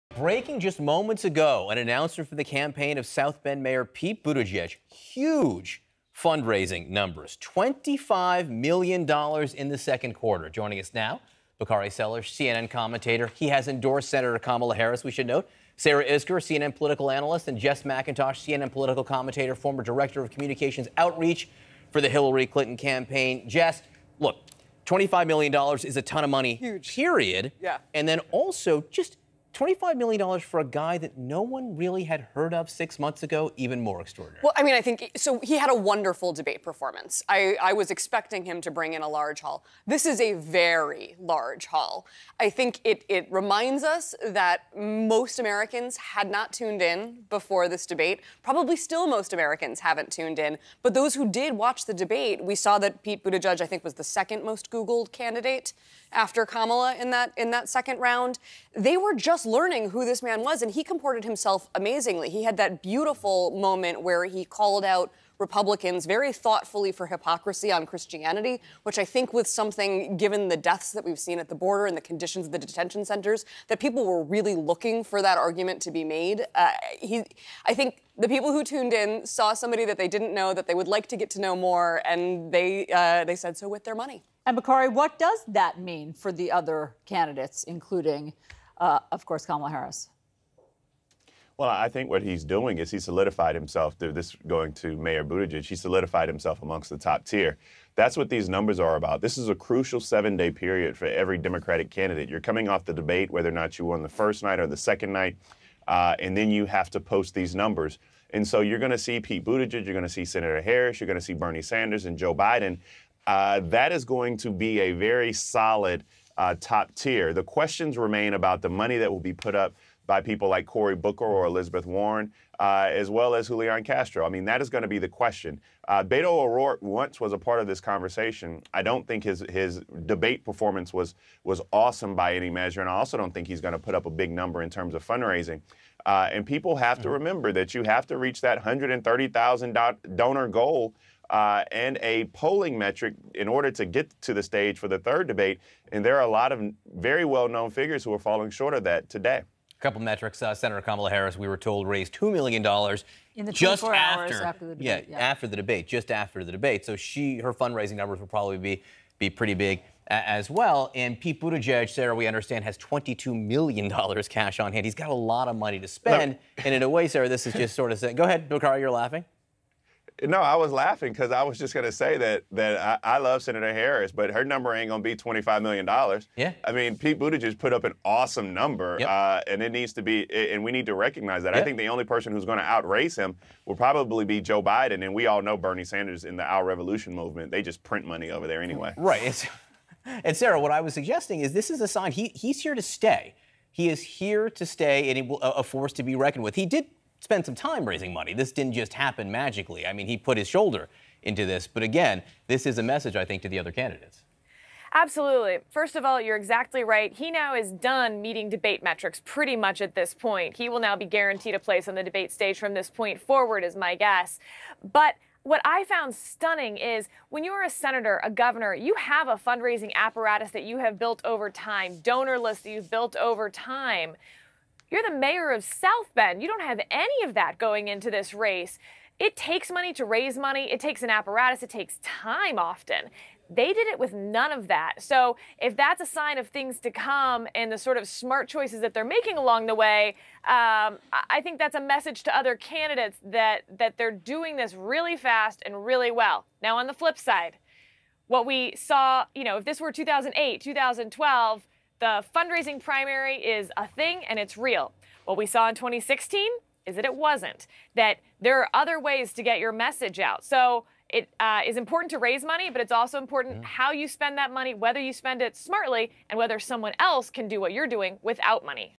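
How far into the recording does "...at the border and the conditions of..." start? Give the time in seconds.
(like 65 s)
71 s.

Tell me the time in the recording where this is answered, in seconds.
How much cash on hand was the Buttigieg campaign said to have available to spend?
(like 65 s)
162 s.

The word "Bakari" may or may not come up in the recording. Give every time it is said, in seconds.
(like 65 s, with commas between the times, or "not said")
11 s, 84 s.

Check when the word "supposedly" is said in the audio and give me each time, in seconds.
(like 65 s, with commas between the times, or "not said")
not said.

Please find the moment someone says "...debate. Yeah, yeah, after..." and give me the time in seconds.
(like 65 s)
154 s.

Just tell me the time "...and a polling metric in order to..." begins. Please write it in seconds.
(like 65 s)
141 s.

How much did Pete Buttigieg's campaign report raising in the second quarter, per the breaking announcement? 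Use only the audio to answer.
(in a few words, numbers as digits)
$25 million.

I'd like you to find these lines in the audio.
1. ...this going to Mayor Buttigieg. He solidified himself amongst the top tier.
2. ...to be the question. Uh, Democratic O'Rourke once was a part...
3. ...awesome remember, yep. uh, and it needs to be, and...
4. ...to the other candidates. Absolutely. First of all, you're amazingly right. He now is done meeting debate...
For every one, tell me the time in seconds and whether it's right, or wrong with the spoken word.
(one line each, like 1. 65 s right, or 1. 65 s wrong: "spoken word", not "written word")
1. 94 s right
2. 124 s wrong: "Beto", not "Democratic"
3. 178 s wrong: "number", not "remember"
4. 203 s wrong: "exactly", not "amazingly".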